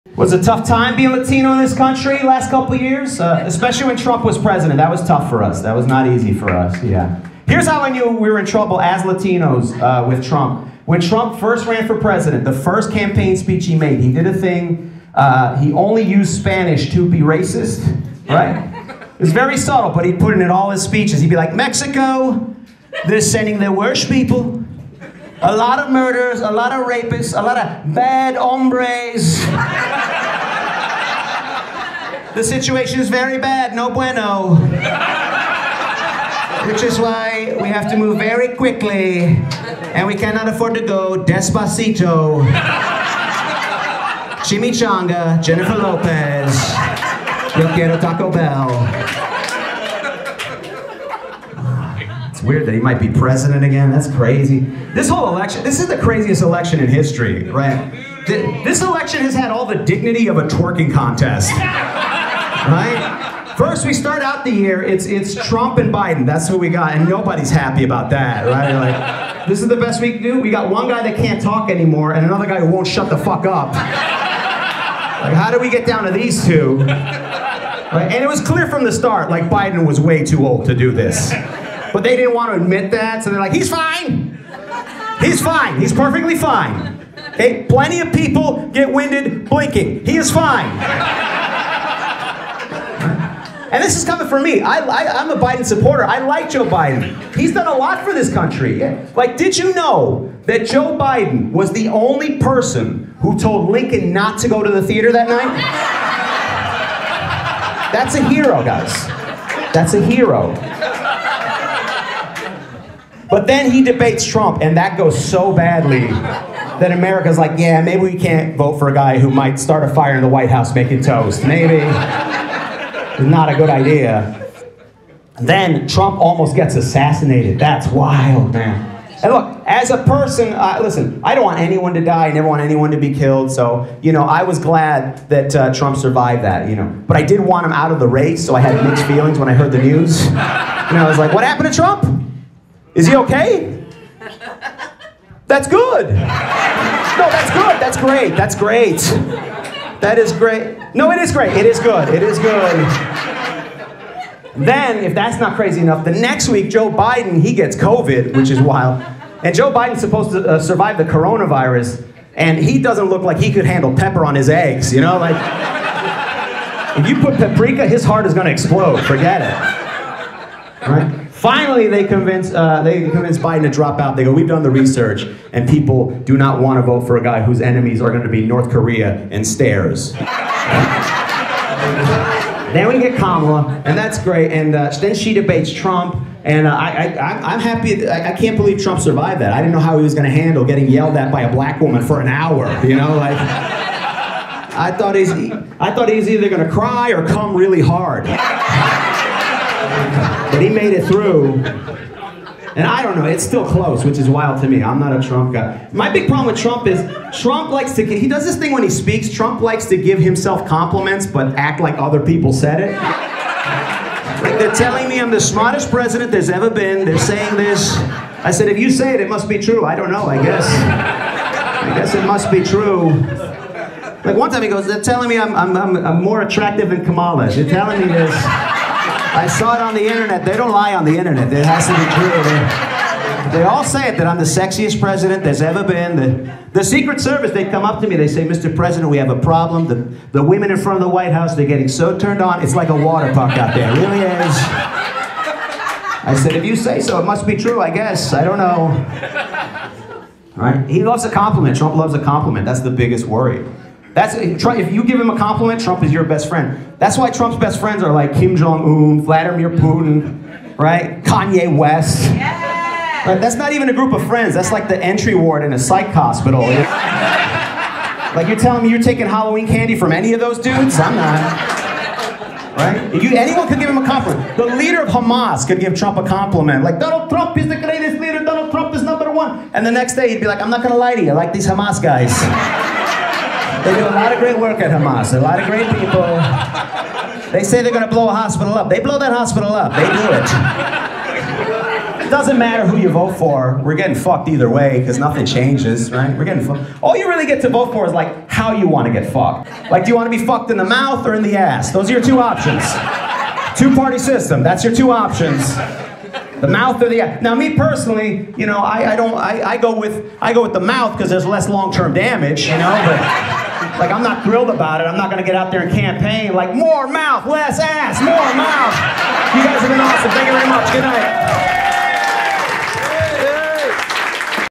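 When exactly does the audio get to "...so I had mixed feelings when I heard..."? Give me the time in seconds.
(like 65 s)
138 s.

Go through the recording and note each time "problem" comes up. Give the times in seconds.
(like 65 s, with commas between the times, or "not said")
206 s, 239 s.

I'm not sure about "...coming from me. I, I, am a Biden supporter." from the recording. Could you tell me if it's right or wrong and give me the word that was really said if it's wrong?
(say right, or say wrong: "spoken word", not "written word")
right.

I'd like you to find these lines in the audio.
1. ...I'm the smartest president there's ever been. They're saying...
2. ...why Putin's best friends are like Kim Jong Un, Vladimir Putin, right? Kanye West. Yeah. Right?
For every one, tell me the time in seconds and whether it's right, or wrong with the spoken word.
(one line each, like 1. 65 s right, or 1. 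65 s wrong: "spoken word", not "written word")
1. 215 s right
2. 257 s wrong: "Trump", not "Putin".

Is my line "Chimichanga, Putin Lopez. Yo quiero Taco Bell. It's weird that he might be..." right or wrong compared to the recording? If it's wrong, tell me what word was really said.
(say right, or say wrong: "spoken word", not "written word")
wrong: "Jennifer", not "Putin".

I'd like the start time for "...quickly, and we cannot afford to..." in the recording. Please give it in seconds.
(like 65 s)
38 s.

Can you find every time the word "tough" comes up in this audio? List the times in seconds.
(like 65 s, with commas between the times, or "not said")
0 s, 5 s.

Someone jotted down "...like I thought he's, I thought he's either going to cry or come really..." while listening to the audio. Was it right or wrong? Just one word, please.
right.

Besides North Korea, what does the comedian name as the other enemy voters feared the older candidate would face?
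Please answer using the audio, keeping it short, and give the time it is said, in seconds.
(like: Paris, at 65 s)
Stairs, at 179 s.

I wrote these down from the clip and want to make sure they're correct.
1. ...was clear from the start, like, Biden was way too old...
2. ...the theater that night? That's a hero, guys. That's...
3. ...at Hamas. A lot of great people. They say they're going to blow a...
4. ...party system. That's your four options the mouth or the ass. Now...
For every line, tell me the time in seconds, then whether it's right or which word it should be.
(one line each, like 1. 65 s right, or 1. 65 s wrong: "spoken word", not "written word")
1. 78 s right
2. 104 s right
3. 284 s right
4. 303 s wrong: "two", not "four".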